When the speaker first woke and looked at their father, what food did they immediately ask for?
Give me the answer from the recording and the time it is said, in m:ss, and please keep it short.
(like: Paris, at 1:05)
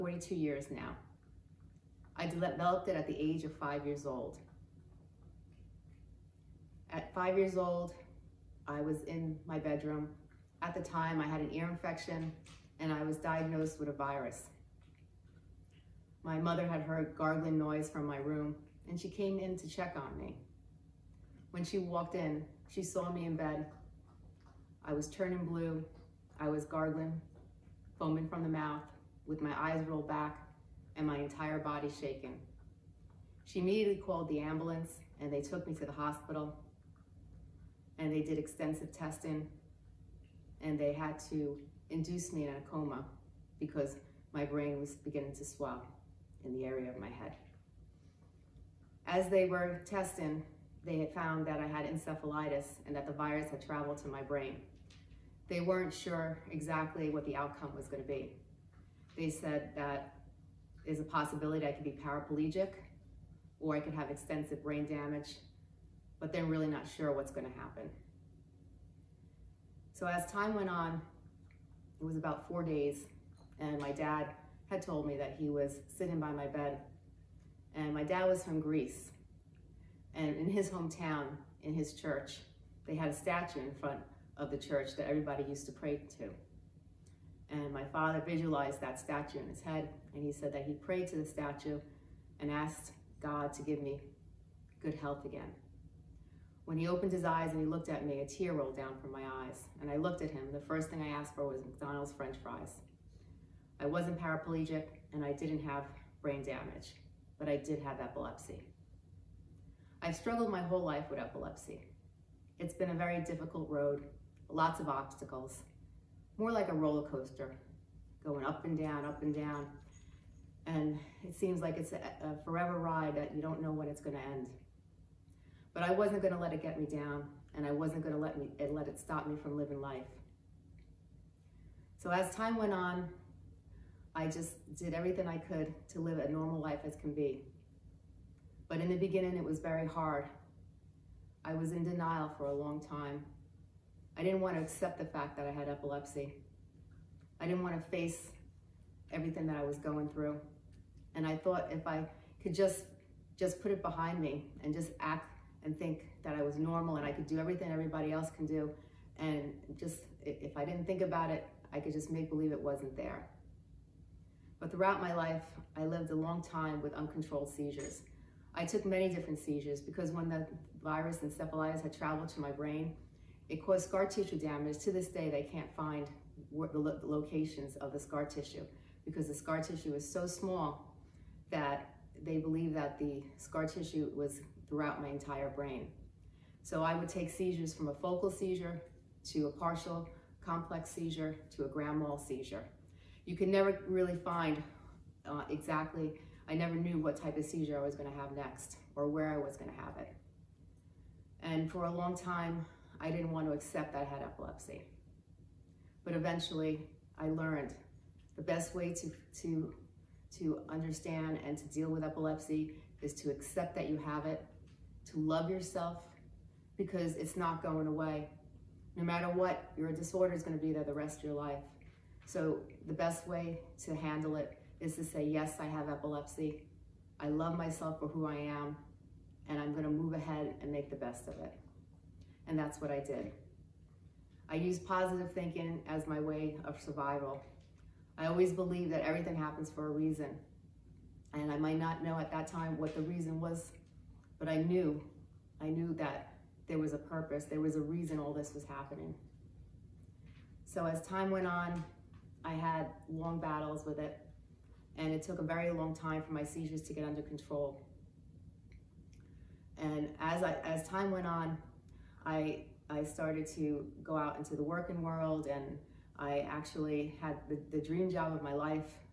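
McDonald's french fries, at 1:41.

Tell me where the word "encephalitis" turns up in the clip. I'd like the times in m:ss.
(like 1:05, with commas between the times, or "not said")
0:51, 2:51.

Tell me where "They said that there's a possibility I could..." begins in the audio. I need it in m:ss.
0:59.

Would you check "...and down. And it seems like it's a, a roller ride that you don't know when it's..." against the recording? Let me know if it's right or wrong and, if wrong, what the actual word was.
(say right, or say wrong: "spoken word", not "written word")
wrong: "forever", not "roller".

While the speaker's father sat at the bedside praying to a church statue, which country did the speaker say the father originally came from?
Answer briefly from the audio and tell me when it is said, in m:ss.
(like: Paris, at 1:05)
Greece, at 1:18.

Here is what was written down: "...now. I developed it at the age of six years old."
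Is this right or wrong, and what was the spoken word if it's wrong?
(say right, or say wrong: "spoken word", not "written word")
wrong: "five", not "six".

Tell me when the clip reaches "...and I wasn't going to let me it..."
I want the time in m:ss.
2:07.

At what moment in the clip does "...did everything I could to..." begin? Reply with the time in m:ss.
2:14.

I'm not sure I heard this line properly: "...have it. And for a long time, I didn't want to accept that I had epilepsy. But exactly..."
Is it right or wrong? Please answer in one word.
wrong.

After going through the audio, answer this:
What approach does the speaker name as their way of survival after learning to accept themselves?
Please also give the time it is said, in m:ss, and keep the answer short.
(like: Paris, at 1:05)
positive thinking, at 3:54.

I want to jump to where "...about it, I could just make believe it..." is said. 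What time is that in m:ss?
2:41.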